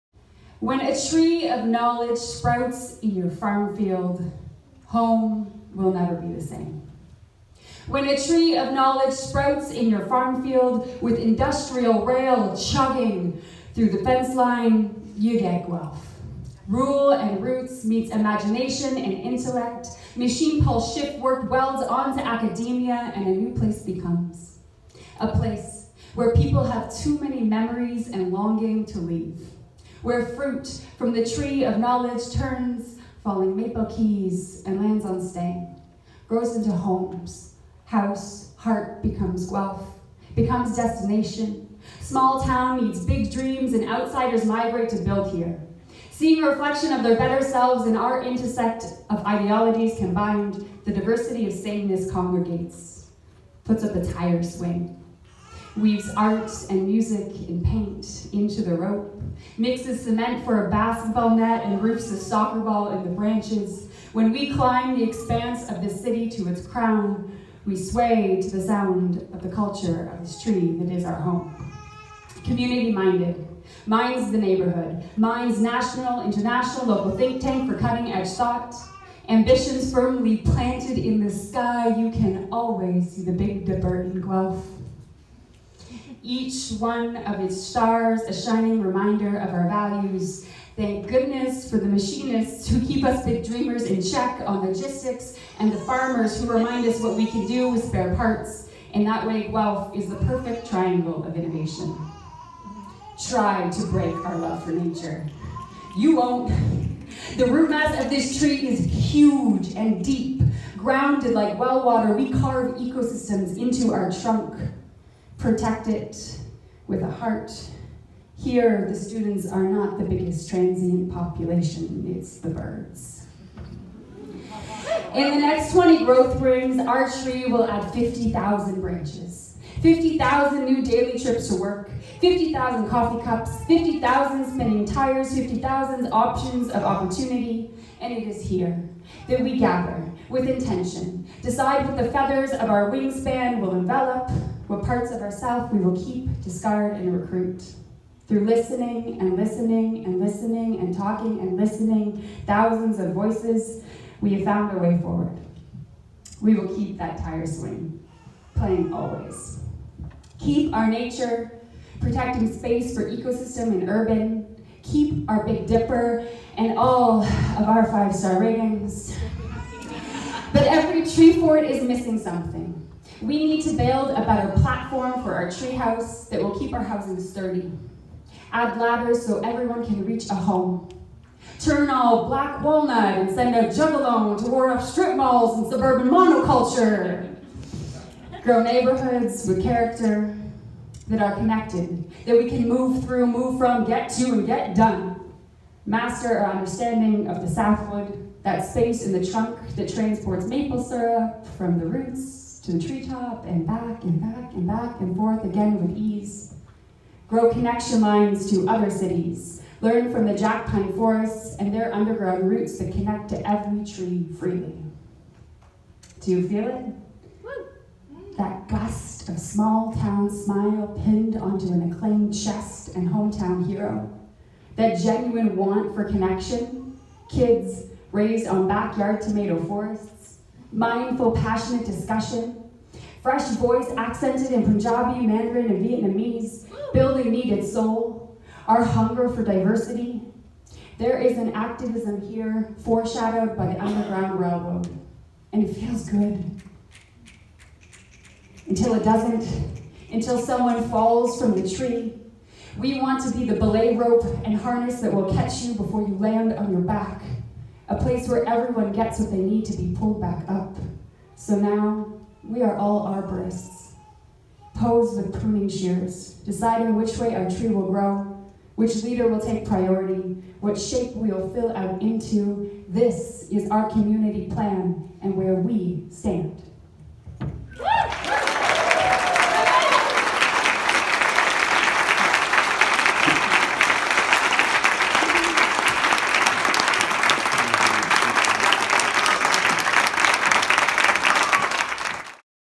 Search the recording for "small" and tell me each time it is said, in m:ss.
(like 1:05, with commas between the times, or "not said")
0:41, 3:39.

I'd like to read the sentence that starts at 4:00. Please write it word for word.
There is an activism here foreshadowed by the Underground Railroad, and it feels good.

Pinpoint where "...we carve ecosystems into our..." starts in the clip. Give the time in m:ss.
1:52.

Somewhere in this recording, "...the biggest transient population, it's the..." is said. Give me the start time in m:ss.
1:59.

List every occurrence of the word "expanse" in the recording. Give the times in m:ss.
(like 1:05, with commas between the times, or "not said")
1:05.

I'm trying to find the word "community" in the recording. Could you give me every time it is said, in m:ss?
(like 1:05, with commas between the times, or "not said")
1:12, 4:33.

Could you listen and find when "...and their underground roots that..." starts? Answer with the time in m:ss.
3:31.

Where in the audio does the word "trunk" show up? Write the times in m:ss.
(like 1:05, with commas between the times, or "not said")
1:54, 3:19.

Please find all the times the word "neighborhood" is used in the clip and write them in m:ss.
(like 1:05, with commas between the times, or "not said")
1:14, 3:08.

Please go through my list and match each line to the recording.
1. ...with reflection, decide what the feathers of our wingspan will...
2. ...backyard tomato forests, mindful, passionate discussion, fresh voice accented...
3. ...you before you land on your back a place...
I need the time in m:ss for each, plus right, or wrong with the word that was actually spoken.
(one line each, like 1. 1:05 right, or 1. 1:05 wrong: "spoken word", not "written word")
1. 2:20 wrong: "intention", not "reflection"
2. 3:48 right
3. 4:15 right.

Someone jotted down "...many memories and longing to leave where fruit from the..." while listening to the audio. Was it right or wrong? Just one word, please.
right.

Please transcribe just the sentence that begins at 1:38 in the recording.
In that way, Guelph is the perfect triangle of innovation.